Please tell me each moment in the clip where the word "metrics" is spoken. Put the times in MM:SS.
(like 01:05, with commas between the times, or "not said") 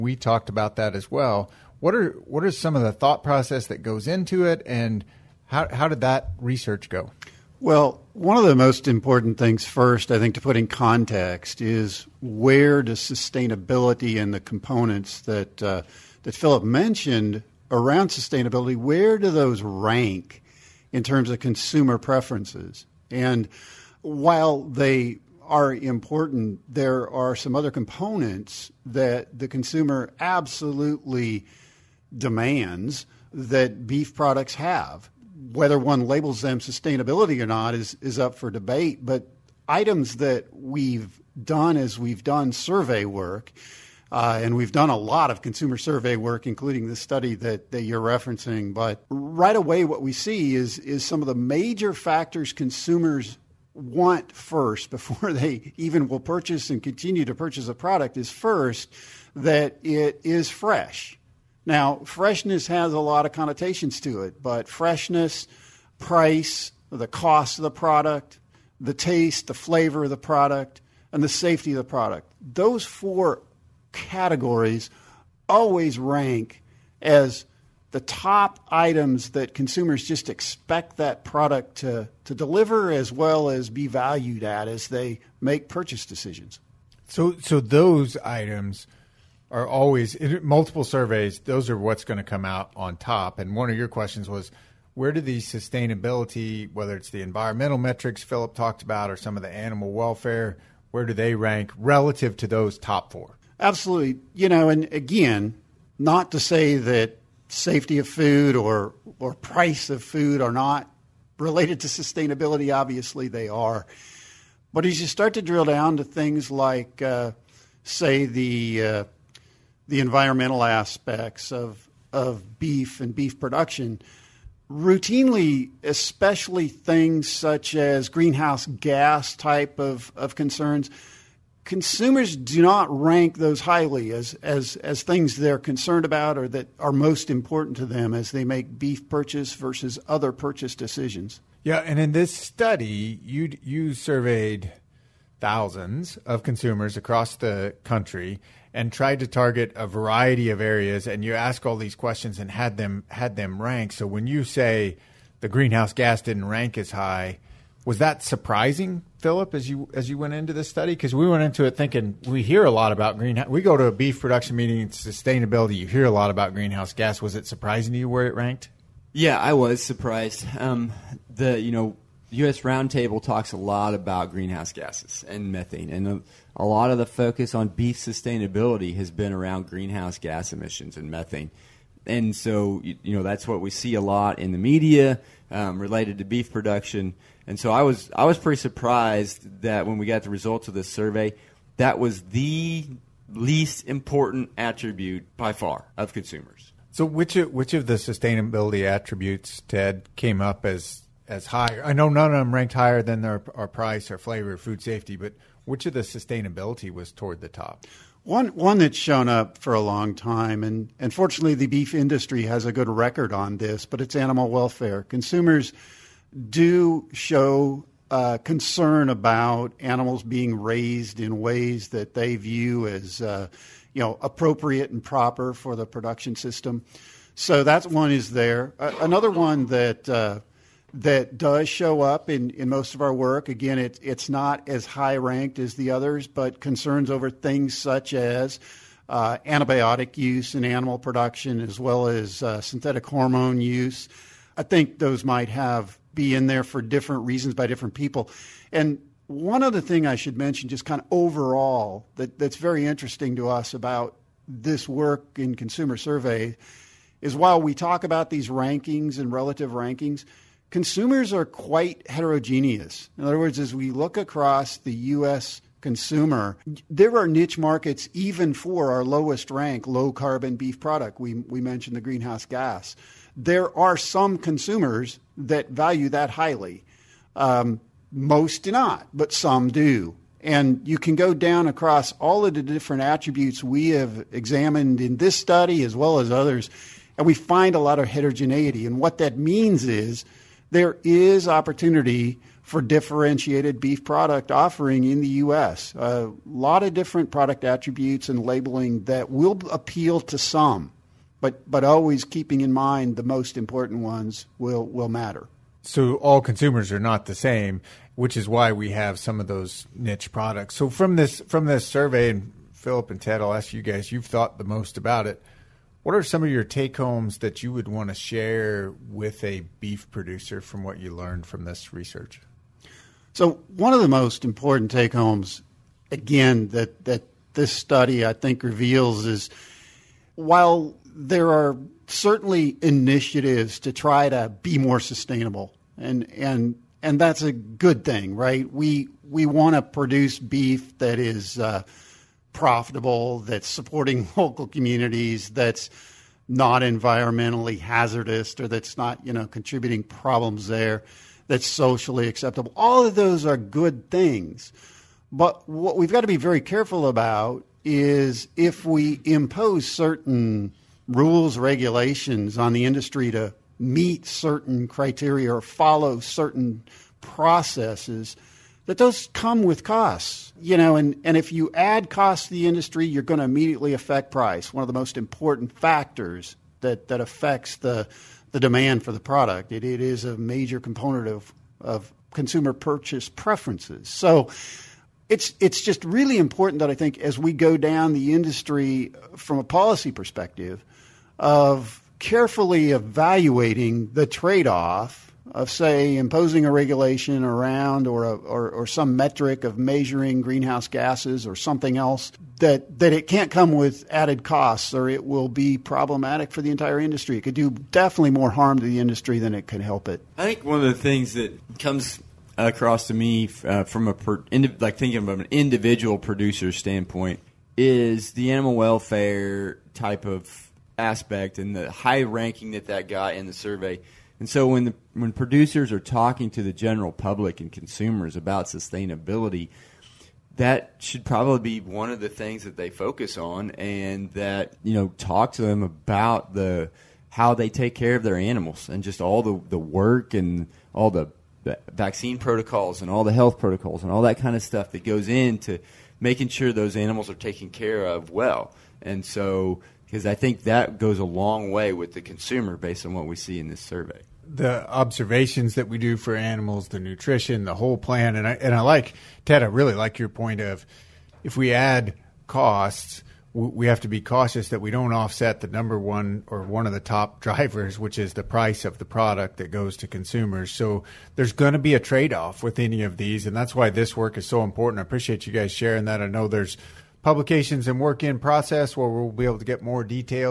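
01:37, 06:39.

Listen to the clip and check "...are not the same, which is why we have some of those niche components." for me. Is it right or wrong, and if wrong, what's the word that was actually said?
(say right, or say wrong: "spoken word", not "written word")
wrong: "products", not "components".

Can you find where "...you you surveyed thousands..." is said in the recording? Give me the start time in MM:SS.
02:23.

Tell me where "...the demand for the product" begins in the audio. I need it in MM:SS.
06:18.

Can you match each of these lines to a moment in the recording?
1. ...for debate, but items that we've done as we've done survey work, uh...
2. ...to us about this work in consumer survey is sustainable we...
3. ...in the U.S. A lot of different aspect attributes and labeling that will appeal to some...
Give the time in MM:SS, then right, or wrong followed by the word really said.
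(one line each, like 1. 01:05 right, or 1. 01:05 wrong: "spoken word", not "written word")
1. 00:38 right
2. 04:13 wrong: "while", not "sustainable"
3. 04:55 wrong: "product", not "aspect".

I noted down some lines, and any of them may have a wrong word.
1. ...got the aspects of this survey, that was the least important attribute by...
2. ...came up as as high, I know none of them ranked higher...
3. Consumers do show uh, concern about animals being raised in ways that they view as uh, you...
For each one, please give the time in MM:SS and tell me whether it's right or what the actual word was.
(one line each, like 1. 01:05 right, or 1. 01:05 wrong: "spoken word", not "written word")
1. 03:10 wrong: "results", not "aspects"
2. 03:20 right
3. 03:35 right.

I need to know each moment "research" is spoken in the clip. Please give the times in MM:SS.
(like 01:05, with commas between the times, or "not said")
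00:06, 05:21.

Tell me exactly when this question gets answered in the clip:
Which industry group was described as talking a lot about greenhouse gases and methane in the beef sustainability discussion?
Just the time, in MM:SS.
02:52.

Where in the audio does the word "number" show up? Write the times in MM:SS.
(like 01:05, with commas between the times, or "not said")
07:45.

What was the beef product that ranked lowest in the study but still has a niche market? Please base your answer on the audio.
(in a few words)
Low carbon beef.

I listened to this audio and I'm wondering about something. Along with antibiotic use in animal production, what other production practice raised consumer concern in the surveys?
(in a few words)
Synthetic hormone use.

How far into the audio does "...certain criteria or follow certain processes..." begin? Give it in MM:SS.
06:04.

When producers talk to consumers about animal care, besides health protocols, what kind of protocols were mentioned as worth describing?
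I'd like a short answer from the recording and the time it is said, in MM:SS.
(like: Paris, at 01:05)
Vaccine protocols, at 07:21.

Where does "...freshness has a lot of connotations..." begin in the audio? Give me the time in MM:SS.
01:02.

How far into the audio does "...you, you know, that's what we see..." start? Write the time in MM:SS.
03:02.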